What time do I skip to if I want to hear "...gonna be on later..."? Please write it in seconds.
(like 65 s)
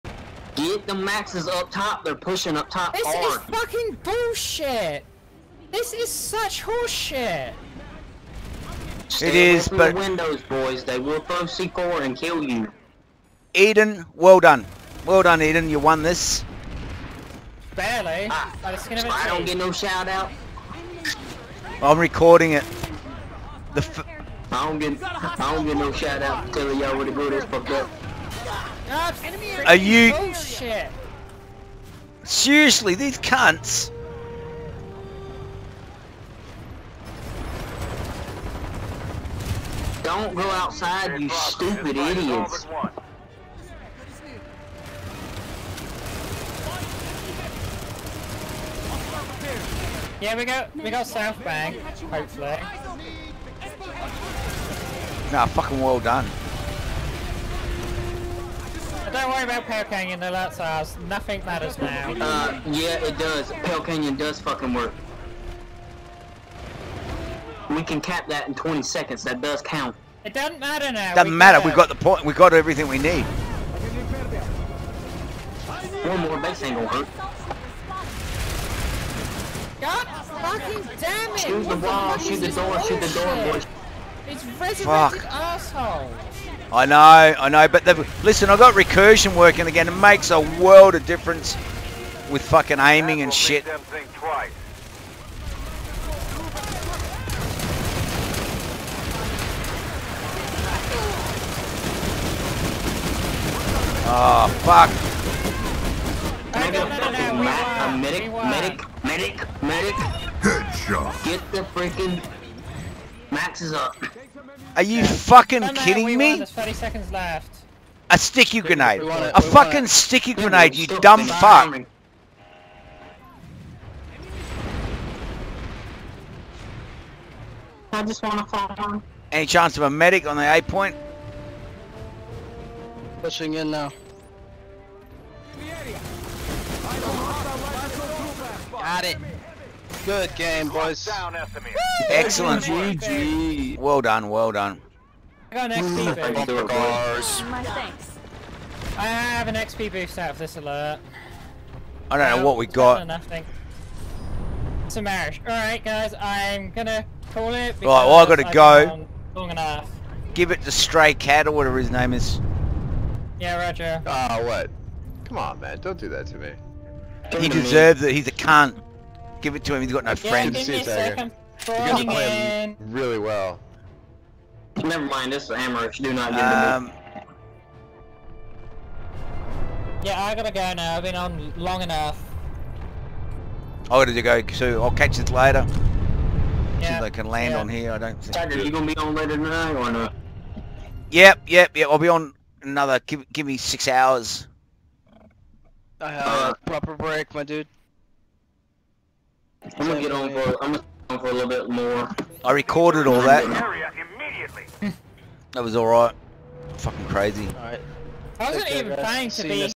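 188 s.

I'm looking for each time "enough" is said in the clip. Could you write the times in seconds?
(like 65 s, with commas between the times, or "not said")
159 s, 181 s.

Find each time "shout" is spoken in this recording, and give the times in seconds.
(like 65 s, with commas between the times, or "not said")
19 s, 25 s.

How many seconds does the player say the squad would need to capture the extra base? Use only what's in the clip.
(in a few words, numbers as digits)
20.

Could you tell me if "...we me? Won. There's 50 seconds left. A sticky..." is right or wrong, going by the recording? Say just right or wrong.
wrong.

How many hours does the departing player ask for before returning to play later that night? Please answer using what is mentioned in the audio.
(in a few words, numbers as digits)
6.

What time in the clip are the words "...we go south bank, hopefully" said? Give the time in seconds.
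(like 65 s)
50 s.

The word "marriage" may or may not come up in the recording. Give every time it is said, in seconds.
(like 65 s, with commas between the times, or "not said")
155 s.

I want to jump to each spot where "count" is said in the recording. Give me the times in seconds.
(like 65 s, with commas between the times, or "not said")
69 s.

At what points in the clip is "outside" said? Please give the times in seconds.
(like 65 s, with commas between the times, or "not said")
40 s.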